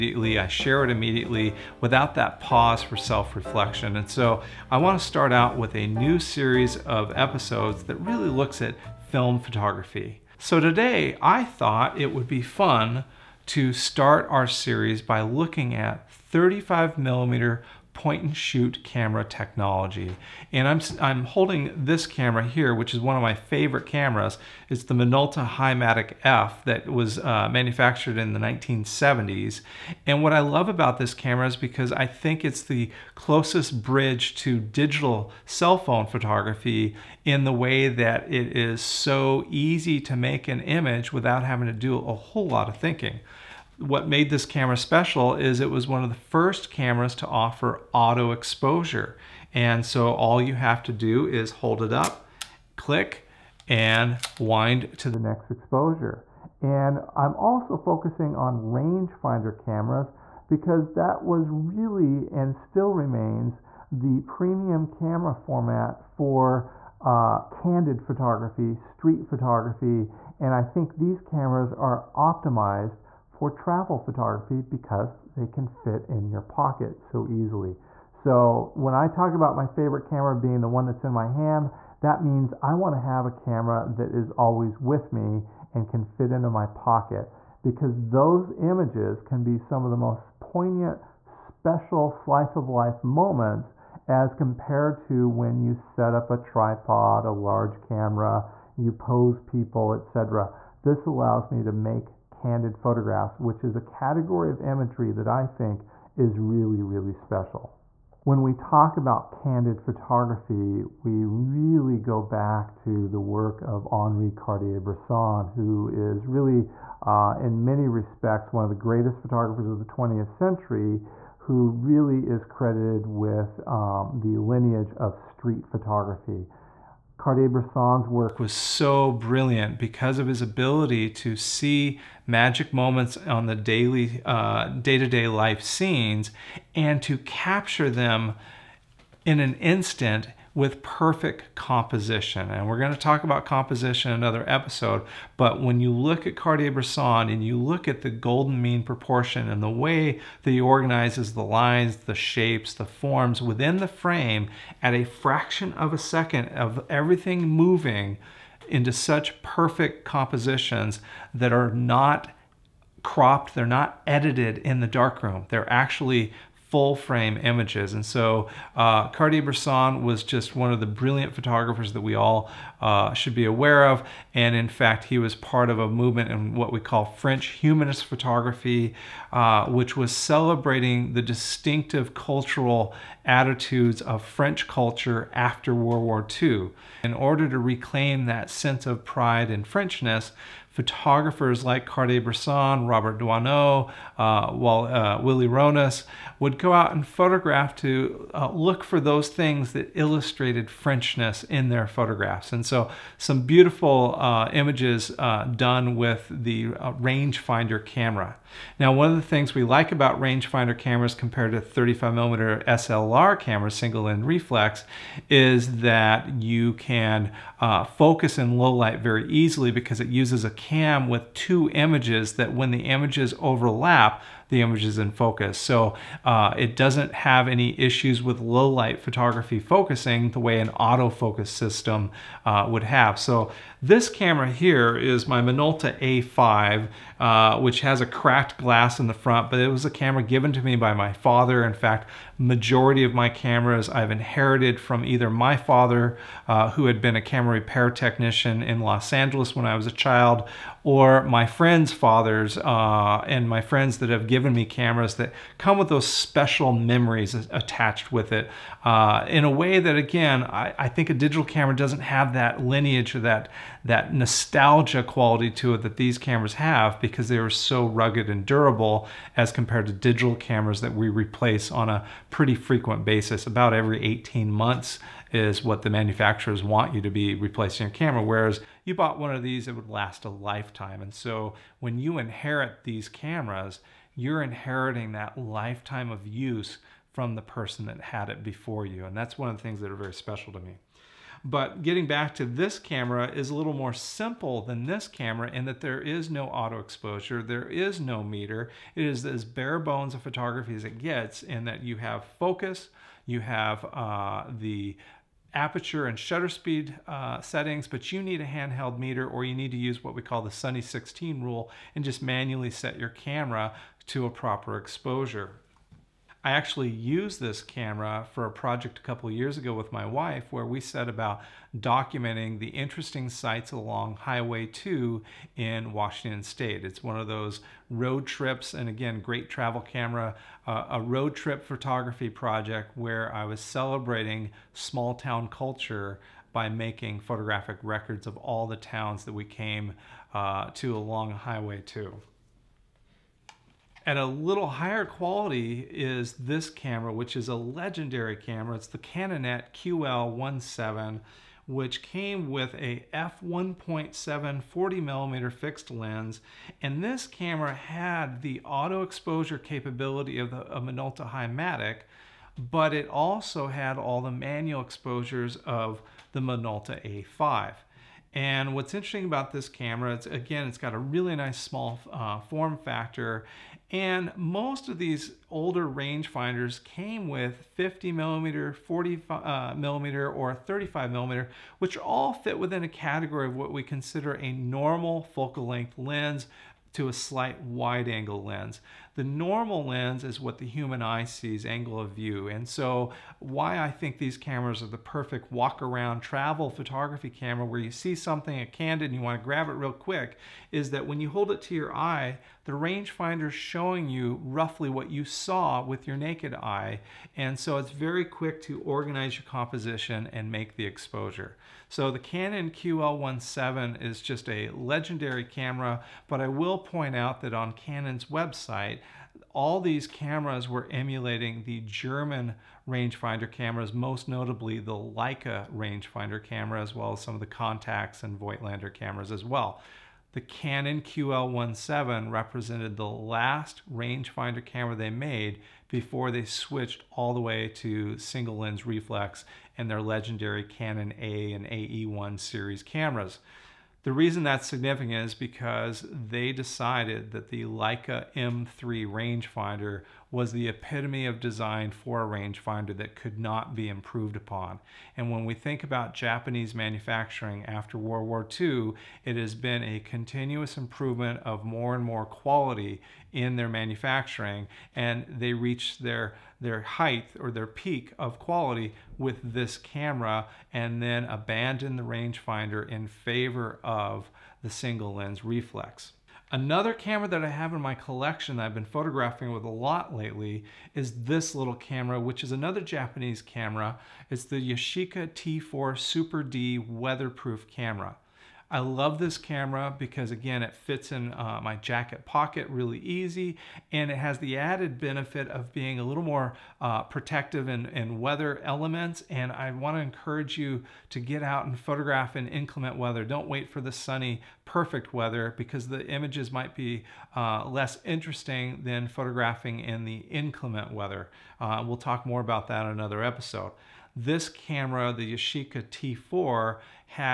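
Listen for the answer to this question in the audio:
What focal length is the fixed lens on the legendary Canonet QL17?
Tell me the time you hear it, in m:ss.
5:54.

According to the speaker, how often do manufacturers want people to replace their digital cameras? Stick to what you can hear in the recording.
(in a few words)
Every 18 months.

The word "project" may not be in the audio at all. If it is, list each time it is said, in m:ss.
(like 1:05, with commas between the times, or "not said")
5:18, 5:32.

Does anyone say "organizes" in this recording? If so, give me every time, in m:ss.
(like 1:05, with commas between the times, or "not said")
2:30, 6:48.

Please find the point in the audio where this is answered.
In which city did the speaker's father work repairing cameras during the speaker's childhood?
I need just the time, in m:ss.
4:08.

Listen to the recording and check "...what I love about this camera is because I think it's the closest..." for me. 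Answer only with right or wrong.
right.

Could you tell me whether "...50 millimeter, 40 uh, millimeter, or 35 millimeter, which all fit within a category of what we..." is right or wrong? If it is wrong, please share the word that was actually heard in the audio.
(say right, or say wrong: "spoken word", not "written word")
right.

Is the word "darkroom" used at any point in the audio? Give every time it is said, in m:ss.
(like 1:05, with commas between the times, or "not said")
2:44.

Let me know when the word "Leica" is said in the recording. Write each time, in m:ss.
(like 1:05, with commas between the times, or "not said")
7:04, 7:27.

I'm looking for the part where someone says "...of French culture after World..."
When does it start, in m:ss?
3:03.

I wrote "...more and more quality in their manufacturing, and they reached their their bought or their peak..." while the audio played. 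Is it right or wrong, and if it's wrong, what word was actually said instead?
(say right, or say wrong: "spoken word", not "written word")
wrong: "height", not "bought".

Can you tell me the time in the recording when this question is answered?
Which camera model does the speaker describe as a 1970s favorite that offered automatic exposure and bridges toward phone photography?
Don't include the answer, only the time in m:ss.
0:24.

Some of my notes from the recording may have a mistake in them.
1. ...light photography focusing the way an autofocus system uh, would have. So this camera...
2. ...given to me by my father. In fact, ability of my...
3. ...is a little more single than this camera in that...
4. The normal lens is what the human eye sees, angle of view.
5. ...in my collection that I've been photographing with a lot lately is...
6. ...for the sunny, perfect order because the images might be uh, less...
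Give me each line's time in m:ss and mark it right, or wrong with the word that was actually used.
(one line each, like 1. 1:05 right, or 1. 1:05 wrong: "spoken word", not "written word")
1. 3:48 right
2. 4:00 wrong: "majority", not "ability"
3. 4:53 wrong: "simple", not "single"
4. 6:29 right
5. 7:57 right
6. 8:23 wrong: "weather", not "order".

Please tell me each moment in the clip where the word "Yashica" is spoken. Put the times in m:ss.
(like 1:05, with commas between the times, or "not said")
8:04, 8:35.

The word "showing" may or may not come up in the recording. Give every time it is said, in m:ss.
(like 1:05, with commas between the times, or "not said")
6:43.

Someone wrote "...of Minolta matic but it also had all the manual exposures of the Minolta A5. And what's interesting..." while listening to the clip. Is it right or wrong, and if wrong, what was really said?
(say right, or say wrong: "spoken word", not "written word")
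right.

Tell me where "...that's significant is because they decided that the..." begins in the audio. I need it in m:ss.
7:24.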